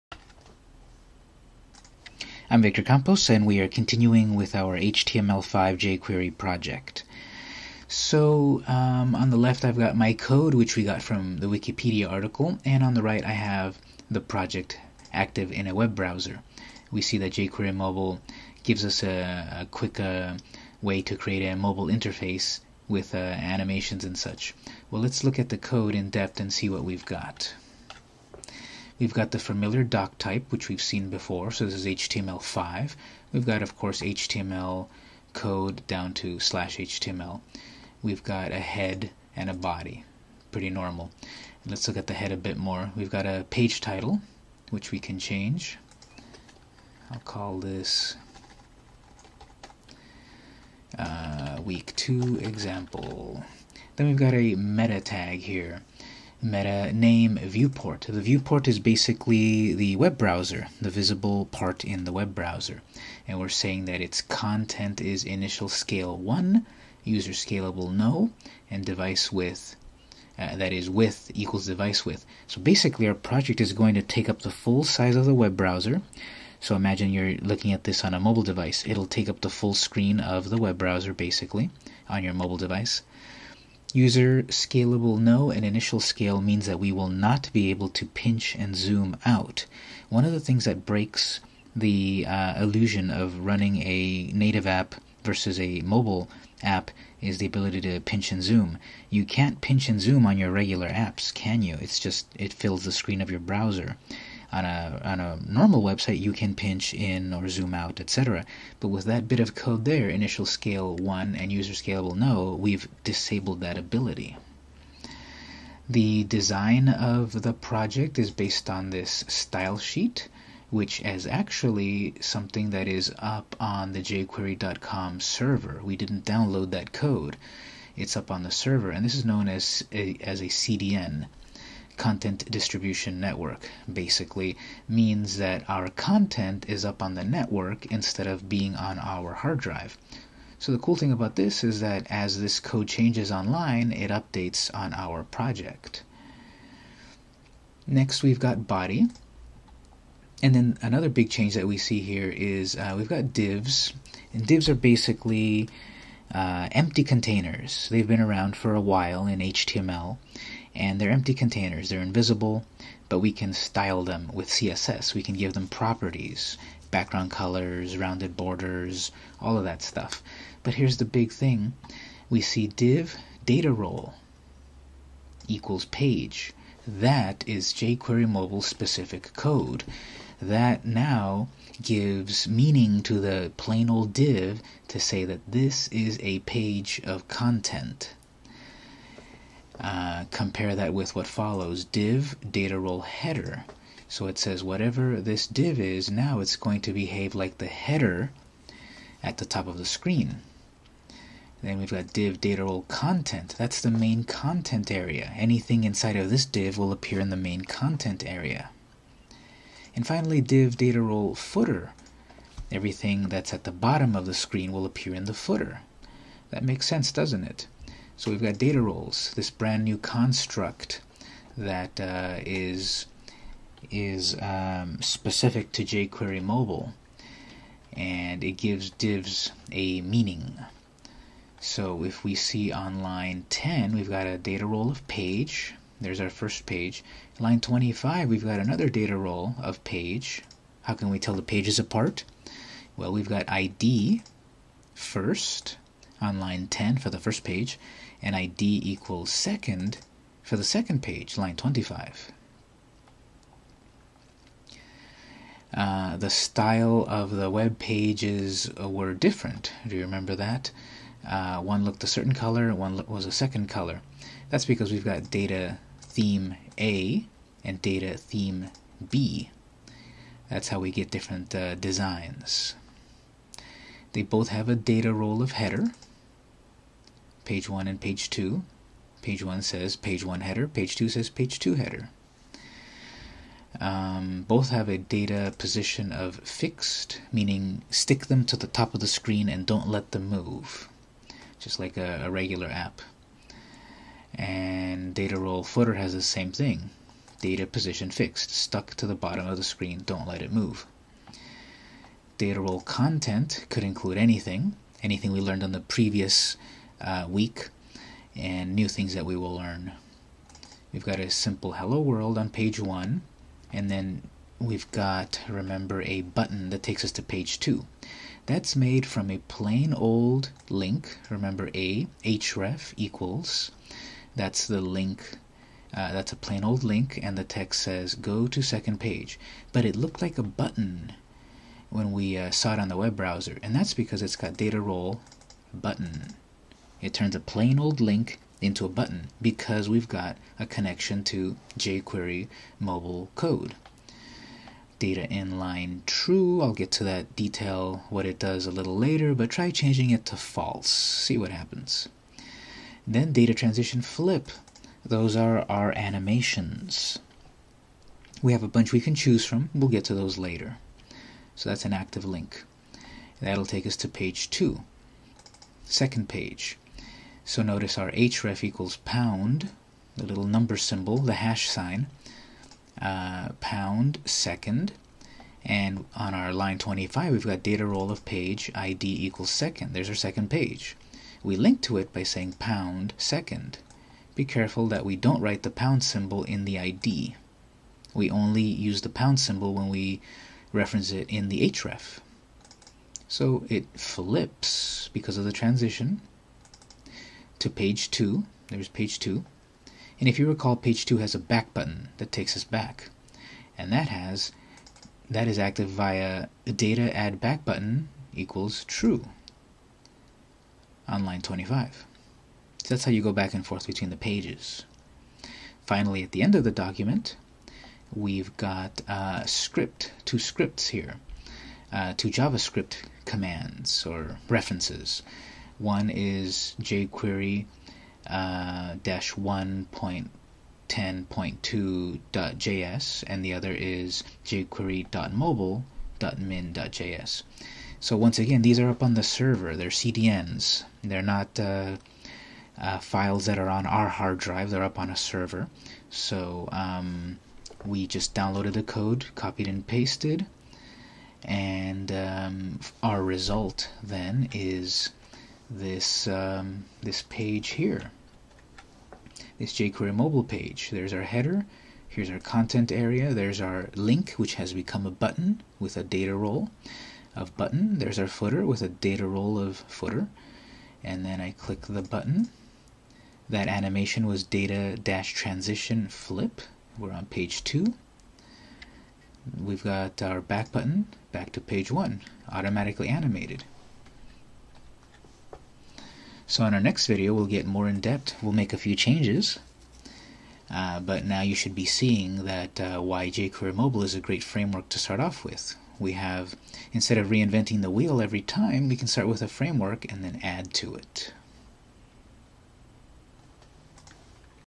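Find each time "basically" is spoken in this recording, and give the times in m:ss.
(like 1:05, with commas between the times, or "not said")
0:58, 1:12, 1:21, 2:14, 2:34.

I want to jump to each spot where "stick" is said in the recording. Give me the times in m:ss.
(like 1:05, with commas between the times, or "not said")
4:47.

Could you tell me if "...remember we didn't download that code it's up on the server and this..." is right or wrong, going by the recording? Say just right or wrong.
wrong.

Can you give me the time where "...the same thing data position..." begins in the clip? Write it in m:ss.
4:56.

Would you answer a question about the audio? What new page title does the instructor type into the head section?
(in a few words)
week 2 example.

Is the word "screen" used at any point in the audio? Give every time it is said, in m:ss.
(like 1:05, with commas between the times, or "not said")
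1:19, 1:42, 3:19, 3:34, 4:49, 4:59.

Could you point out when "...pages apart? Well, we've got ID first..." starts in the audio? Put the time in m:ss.
4:01.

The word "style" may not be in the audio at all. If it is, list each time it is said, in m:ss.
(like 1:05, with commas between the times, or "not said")
1:59, 2:43, 4:16.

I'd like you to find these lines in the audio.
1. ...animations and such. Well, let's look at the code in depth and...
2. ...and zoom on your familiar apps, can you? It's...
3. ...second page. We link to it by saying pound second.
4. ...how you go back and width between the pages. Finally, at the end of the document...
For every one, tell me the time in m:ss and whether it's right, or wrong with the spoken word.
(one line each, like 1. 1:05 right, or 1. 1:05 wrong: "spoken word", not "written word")
1. 0:23 right
2. 1:39 wrong: "regular", not "familiar"
3. 6:20 right
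4. 6:53 wrong: "forth", not "width".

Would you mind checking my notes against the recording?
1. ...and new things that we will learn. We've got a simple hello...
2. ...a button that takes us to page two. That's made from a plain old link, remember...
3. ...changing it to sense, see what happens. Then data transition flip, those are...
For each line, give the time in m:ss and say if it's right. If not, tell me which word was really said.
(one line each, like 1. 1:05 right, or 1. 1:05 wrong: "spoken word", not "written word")
1. 5:08 right
2. 5:16 right
3. 5:49 wrong: "false", not "sense".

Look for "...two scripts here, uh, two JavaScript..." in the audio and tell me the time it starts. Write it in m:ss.
7:00.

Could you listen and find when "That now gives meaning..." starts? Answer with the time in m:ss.
3:00.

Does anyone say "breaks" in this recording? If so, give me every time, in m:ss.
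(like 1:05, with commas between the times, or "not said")
1:30.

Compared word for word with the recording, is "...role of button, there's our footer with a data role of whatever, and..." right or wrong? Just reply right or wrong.
wrong.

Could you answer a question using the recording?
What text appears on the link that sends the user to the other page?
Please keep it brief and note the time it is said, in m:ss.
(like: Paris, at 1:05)
go to second page, at 5:28.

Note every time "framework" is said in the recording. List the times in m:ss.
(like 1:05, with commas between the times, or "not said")
8:14, 8:19.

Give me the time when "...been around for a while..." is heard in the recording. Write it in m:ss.
2:38.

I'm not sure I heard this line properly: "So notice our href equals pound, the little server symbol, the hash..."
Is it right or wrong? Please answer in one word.
wrong.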